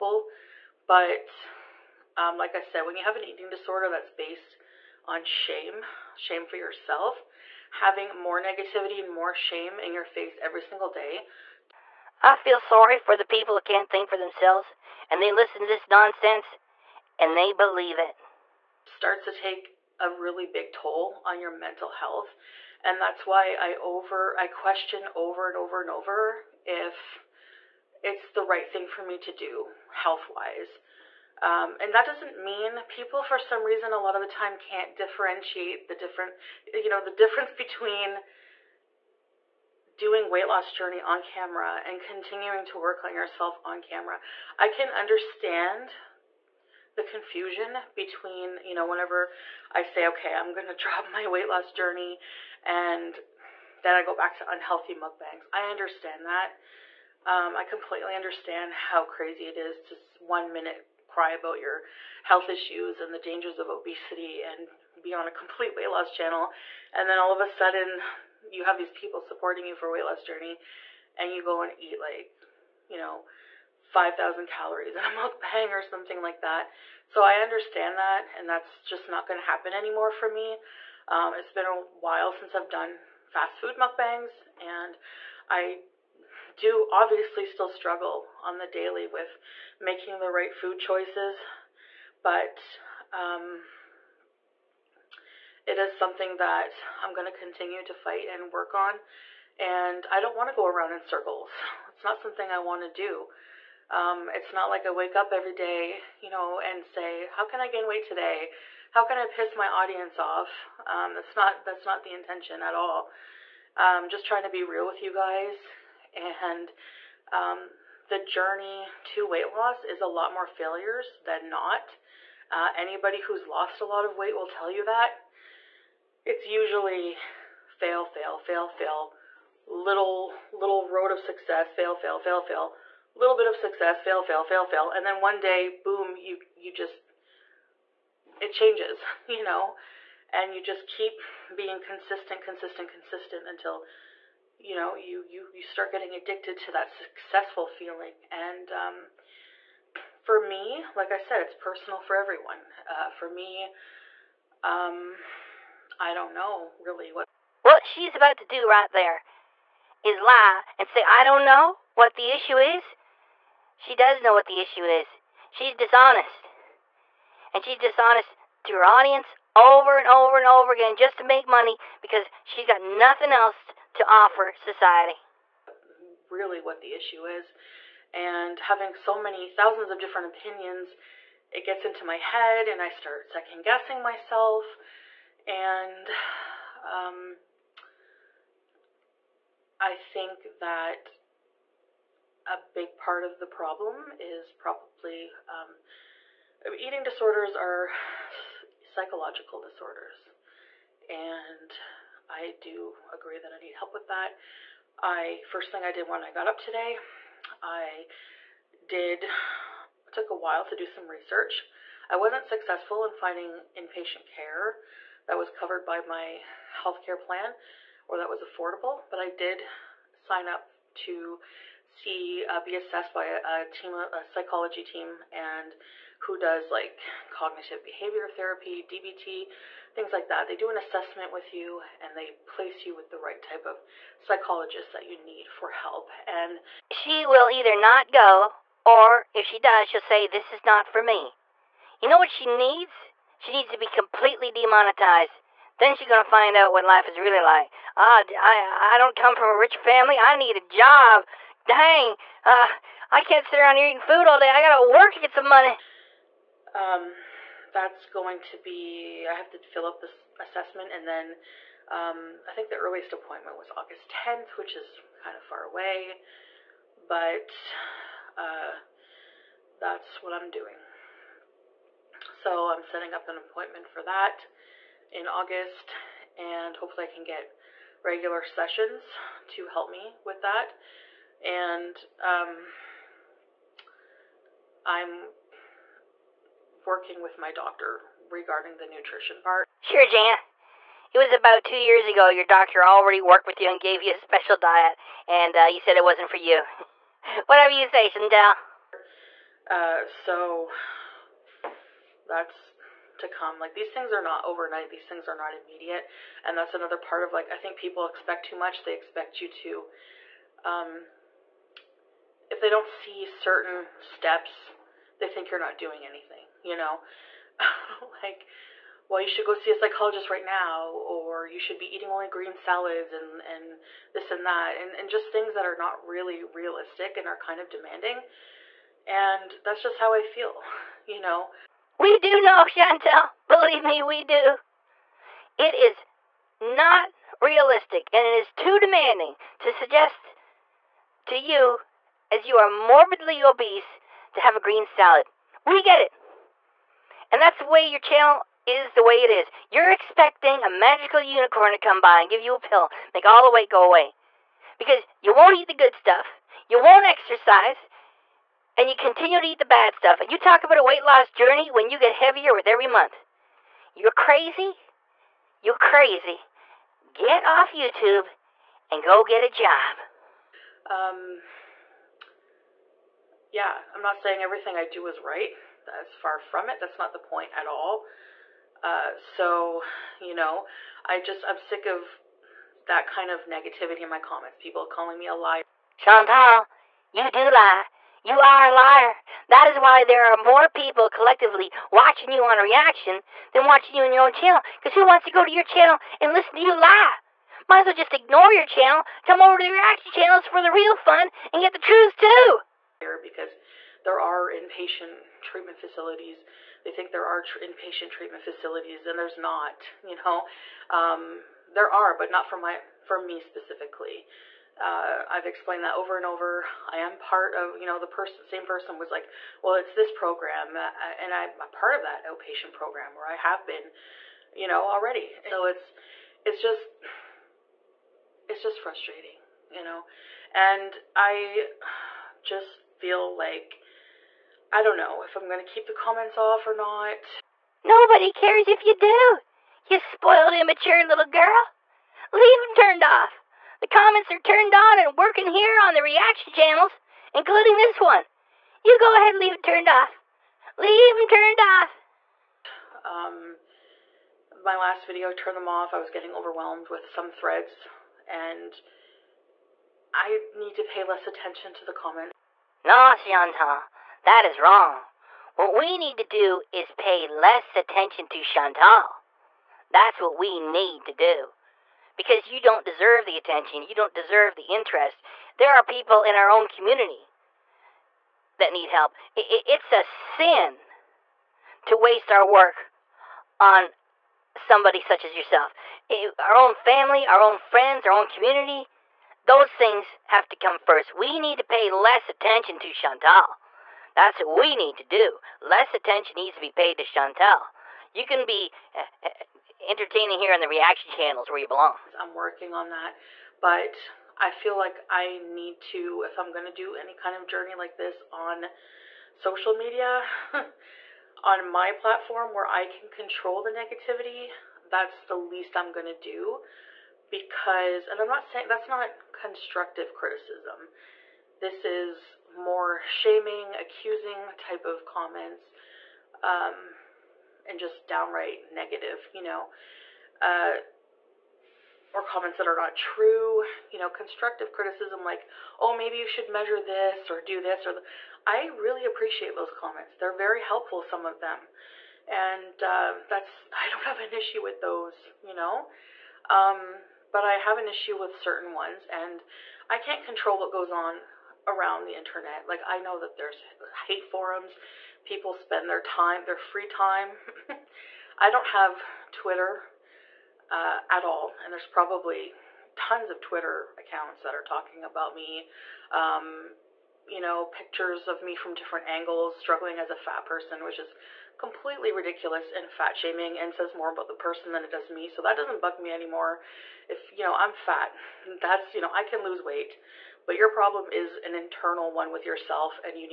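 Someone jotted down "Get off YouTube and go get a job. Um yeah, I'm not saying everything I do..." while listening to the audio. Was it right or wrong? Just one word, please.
right.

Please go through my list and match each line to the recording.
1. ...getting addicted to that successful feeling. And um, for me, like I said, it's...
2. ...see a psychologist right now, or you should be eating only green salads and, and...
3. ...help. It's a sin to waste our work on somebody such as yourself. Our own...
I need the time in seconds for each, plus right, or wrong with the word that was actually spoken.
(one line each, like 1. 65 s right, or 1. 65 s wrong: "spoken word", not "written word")
1. 145 s right
2. 319 s right
3. 478 s right.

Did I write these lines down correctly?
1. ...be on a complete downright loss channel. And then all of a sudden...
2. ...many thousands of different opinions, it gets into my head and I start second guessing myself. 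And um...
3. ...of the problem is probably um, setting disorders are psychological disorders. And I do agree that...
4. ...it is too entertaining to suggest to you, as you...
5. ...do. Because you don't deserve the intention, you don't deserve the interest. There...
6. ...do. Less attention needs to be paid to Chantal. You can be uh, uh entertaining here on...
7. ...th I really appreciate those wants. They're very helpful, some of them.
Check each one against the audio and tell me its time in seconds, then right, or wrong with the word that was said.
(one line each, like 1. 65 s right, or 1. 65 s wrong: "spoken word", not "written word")
1. 64 s wrong: "weight", not "downright"
2. 179 s right
3. 193 s wrong: "eating", not "setting"
4. 338 s wrong: "demanding", not "entertaining"
5. 471 s wrong: "attention", not "intention"
6. 495 s right
7. 537 s wrong: "comments", not "wants".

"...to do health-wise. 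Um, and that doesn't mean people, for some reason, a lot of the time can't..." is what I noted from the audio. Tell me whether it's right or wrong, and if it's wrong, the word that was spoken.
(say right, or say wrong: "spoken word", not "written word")
right.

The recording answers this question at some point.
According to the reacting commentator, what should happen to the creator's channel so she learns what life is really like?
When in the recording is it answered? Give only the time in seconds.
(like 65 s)
243 s.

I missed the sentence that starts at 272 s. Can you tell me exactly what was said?
So I'm setting up an appointment for that in August and hopefully I can get regular sessions to help me with that.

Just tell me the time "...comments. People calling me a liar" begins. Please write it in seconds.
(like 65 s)
384 s.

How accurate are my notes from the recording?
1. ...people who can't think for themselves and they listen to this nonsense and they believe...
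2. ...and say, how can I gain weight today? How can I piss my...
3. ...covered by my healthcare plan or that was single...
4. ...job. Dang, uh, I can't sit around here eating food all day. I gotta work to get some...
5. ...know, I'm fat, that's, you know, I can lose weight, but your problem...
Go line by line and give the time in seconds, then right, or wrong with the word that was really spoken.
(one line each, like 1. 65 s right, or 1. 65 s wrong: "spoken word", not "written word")
1. 13 s right
2. 106 s right
3. 215 s wrong: "affordable", not "single"
4. 250 s right
5. 577 s right.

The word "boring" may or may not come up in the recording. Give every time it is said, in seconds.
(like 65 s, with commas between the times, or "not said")
not said.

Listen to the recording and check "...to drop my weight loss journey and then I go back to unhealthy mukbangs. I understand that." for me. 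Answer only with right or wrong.
right.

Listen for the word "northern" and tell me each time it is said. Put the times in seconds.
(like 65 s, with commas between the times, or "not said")
not said.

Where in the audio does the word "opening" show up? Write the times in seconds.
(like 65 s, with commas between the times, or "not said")
not said.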